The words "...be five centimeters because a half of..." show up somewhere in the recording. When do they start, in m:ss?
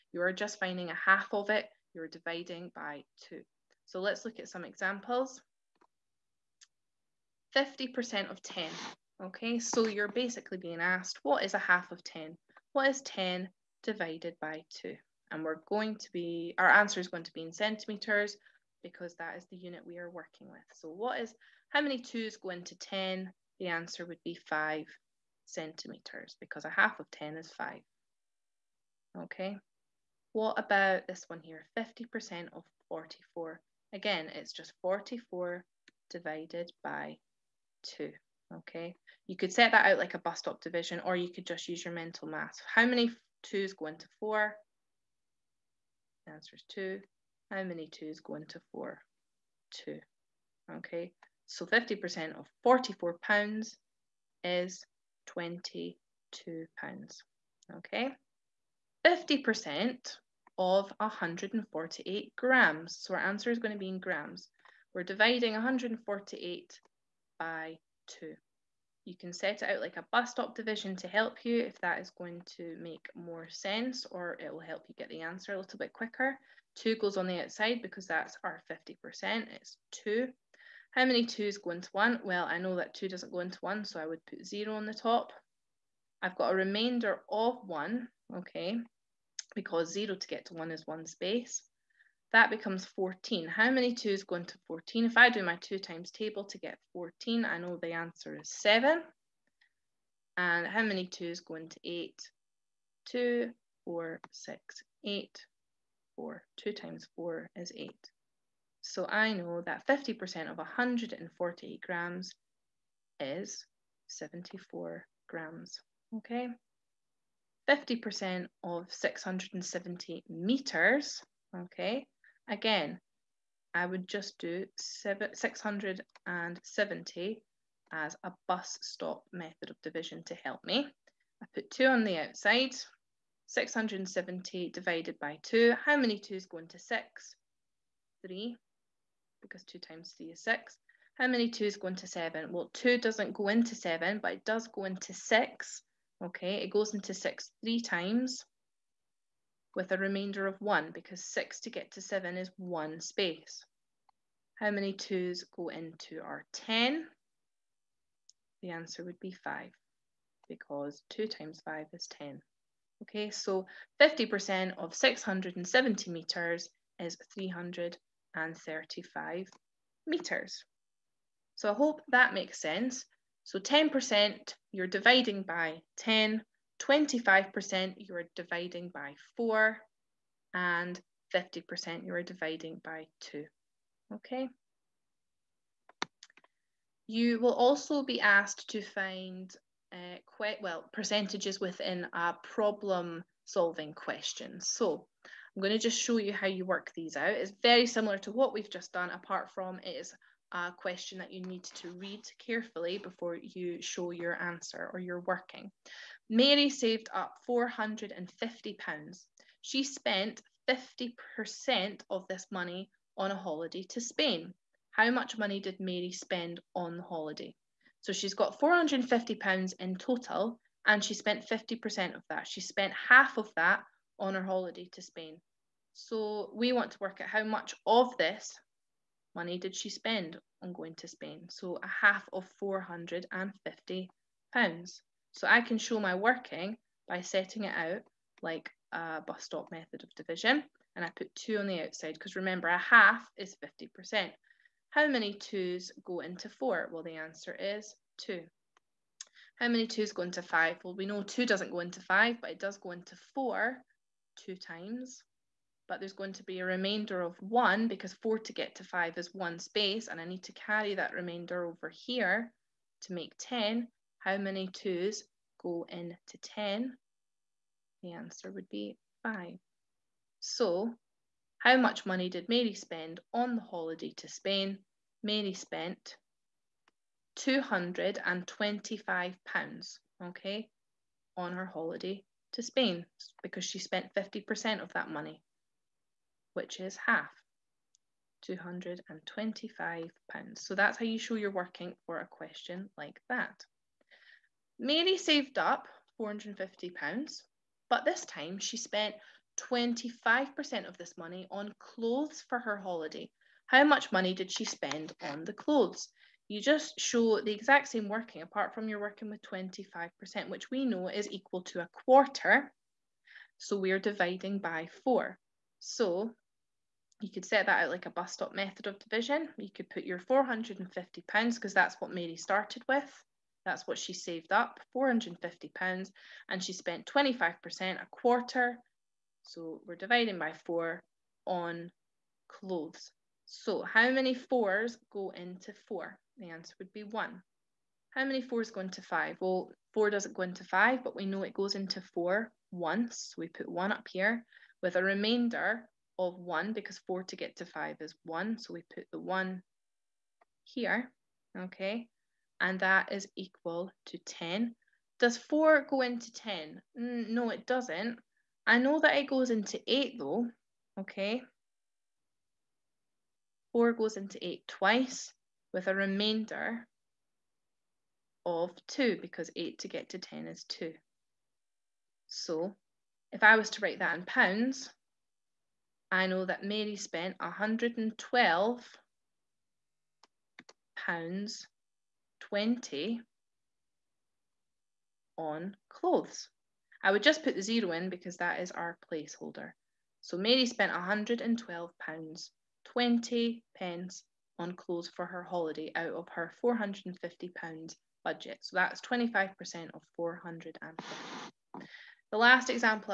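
0:24.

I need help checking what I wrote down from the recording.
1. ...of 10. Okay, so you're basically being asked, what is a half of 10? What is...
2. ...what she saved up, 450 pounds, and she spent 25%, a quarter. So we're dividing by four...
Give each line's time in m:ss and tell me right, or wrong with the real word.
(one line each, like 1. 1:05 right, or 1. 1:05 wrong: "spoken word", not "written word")
1. 0:08 right
2. 5:23 right.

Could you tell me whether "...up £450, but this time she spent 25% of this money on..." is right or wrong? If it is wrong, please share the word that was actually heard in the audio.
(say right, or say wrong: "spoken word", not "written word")
right.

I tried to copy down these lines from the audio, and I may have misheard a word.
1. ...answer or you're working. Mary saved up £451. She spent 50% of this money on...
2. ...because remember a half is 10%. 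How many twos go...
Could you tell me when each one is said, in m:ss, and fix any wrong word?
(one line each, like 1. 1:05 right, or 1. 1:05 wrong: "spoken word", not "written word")
1. 3:24 wrong: "450", not "451"
2. 4:02 wrong: "50", not "10".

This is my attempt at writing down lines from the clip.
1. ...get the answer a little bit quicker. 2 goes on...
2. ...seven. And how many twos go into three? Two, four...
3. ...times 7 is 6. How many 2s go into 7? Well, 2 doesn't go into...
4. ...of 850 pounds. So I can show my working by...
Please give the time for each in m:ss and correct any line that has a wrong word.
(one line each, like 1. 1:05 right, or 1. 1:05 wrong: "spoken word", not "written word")
1. 1:14 right
2. 1:38 wrong: "eight", not "three"
3. 2:19 wrong: "3", not "7"
4. 3:52 wrong: "450", not "850".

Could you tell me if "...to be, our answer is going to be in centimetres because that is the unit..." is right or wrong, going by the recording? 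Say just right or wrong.
right.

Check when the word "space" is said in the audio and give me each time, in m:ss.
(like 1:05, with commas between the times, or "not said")
1:31, 2:32, 4:19.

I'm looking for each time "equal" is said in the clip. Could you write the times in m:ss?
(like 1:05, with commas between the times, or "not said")
5:11, 5:53.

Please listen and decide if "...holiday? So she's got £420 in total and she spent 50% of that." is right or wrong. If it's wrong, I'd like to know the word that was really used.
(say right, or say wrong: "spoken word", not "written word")
wrong: "450", not "420".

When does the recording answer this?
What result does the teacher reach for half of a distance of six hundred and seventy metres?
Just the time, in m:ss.
2:47.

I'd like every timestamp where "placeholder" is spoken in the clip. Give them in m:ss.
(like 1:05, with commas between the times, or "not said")
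6:29.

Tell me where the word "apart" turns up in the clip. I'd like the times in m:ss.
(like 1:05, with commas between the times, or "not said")
3:19, 5:08.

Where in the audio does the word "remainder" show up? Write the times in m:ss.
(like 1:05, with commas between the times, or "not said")
1:26, 2:29, 4:16, 4:21, 5:45, 6:05.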